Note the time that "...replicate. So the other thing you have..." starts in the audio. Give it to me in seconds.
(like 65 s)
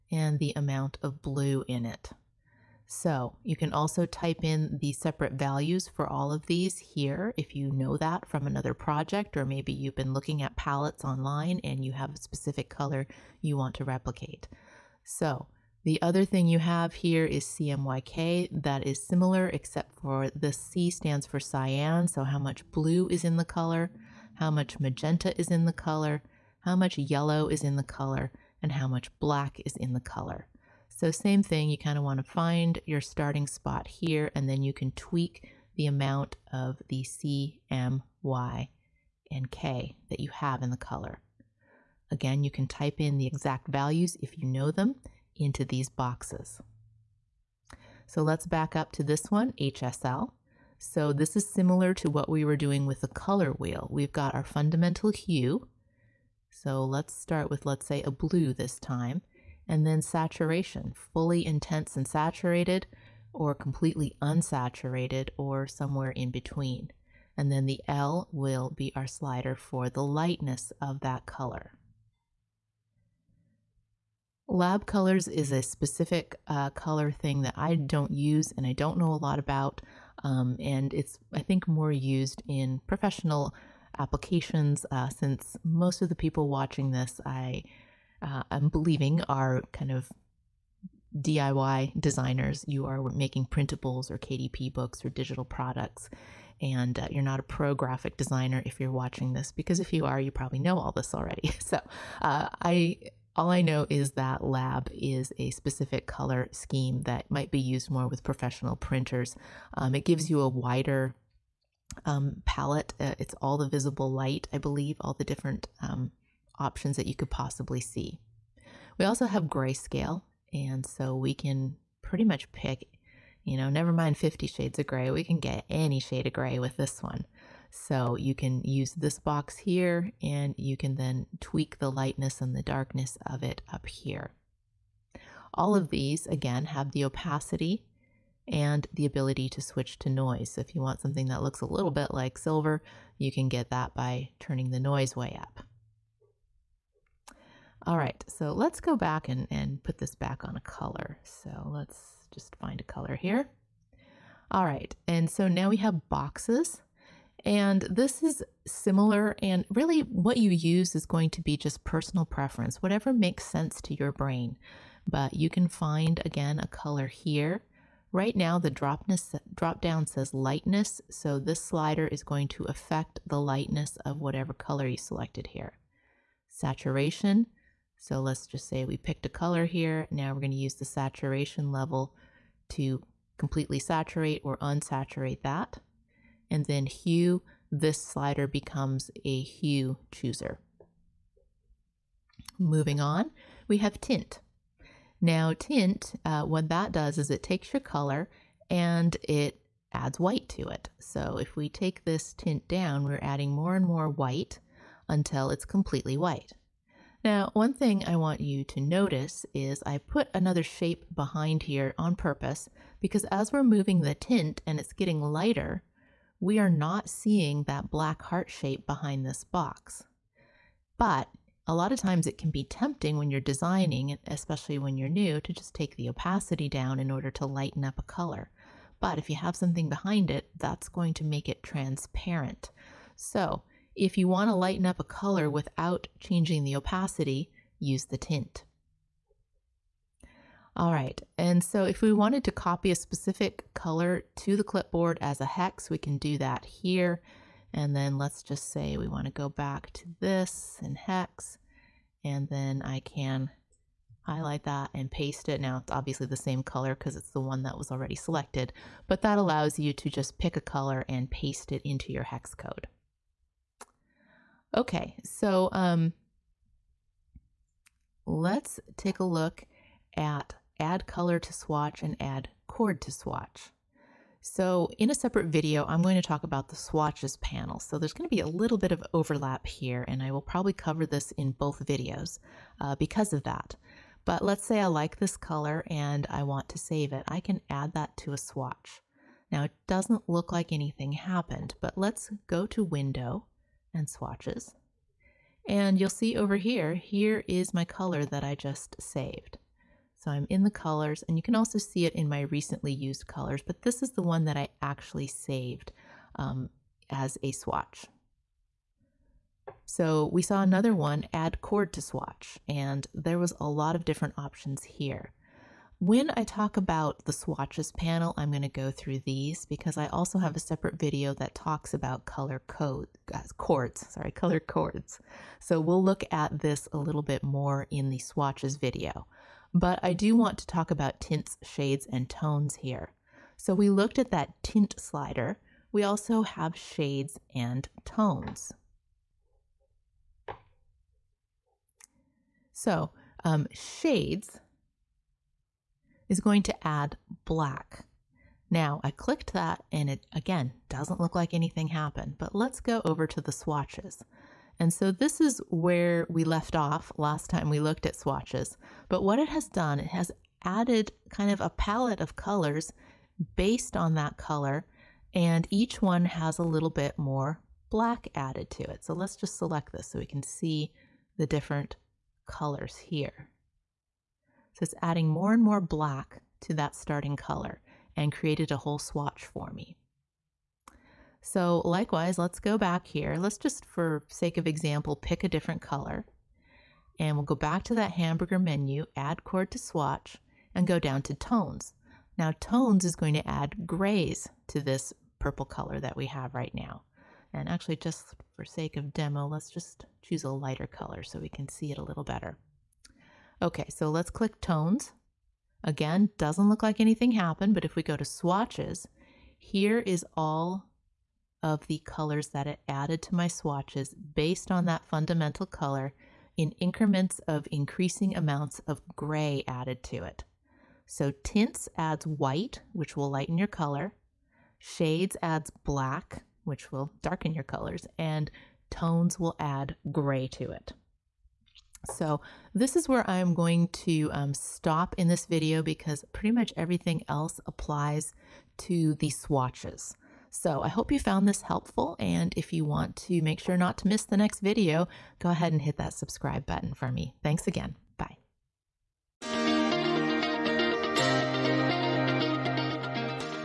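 13 s.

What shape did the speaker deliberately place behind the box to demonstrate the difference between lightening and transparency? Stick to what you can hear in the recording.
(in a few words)
black heart.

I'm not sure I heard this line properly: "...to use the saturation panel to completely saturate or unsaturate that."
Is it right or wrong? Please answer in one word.
wrong.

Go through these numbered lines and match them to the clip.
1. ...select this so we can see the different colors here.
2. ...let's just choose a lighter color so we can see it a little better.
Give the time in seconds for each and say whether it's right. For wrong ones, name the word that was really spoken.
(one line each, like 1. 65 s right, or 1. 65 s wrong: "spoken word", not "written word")
1. 369 s right
2. 399 s right.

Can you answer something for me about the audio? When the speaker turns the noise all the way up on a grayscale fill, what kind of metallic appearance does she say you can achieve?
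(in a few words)
silver.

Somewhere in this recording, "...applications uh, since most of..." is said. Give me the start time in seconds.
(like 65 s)
83 s.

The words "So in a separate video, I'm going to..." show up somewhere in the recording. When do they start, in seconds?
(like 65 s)
274 s.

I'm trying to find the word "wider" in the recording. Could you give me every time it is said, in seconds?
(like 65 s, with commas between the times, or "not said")
110 s.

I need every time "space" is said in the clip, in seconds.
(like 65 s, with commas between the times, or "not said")
not said.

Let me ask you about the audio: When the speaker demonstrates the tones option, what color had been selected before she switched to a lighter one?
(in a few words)
purple.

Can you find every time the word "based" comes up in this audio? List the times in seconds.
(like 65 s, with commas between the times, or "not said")
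363 s, 414 s.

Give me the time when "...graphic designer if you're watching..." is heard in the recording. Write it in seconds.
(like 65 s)
97 s.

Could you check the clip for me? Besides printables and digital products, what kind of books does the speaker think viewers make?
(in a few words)
KDP books.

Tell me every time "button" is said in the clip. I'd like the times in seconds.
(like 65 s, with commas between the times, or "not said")
446 s.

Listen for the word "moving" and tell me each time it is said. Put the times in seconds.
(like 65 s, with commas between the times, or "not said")
192 s, 213 s.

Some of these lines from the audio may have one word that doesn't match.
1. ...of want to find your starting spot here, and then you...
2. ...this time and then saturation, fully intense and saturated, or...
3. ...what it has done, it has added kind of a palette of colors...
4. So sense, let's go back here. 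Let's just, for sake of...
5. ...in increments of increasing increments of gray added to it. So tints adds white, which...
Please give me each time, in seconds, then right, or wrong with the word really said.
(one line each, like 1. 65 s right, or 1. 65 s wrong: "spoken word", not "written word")
1. 31 s right
2. 58 s right
3. 359 s right
4. 381 s wrong: "likewise", not "sense"
5. 416 s wrong: "amounts", not "increments".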